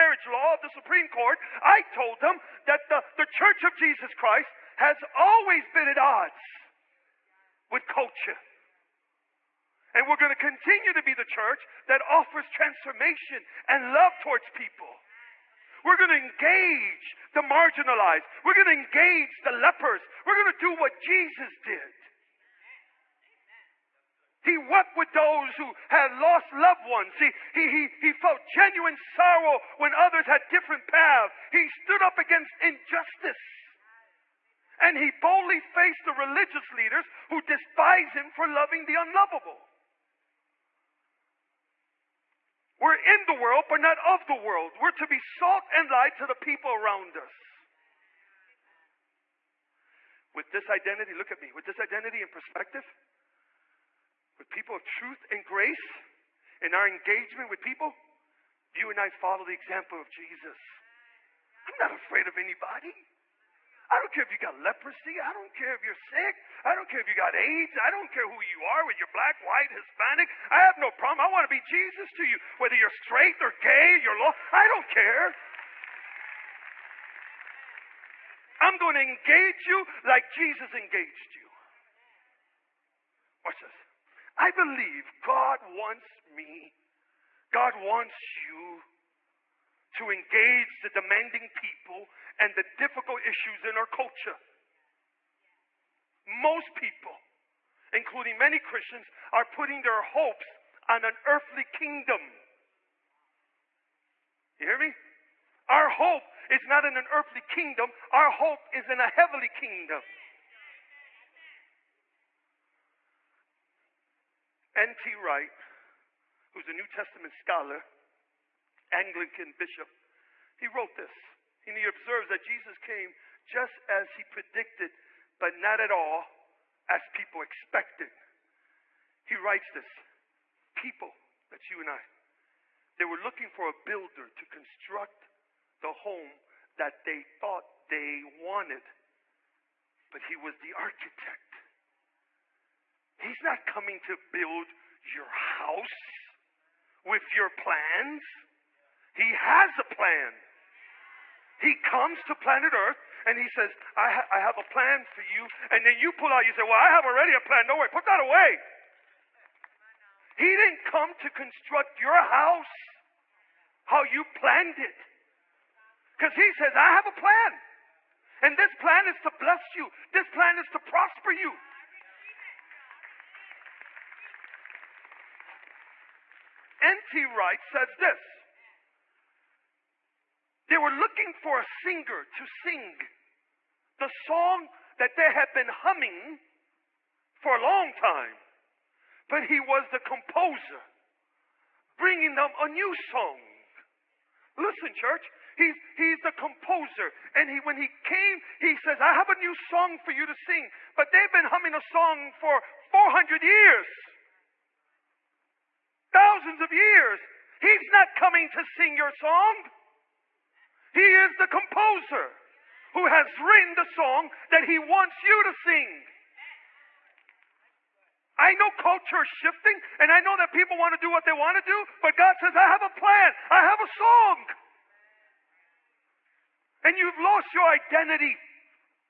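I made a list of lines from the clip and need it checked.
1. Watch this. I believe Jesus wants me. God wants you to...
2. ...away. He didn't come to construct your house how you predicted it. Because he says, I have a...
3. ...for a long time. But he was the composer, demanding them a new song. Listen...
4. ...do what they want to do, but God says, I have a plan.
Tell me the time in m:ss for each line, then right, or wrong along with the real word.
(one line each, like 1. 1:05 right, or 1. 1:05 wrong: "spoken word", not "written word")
1. 1:23 wrong: "God", not "Jesus"
2. 2:38 wrong: "planned", not "predicted"
3. 3:07 wrong: "bringing", not "demanding"
4. 3:41 right.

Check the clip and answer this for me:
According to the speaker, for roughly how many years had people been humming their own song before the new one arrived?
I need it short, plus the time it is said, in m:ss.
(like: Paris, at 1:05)
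400 years, at 3:22.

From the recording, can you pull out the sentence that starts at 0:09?
And we're going to continue to be the church that offers transformation and love towards people.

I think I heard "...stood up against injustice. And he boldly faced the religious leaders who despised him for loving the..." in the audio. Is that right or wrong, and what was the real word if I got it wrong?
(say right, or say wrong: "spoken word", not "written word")
right.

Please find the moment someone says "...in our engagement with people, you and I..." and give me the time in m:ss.
0:56.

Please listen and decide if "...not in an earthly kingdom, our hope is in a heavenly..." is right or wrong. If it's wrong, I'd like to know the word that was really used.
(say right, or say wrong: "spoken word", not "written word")
right.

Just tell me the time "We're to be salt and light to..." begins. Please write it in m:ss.
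0:44.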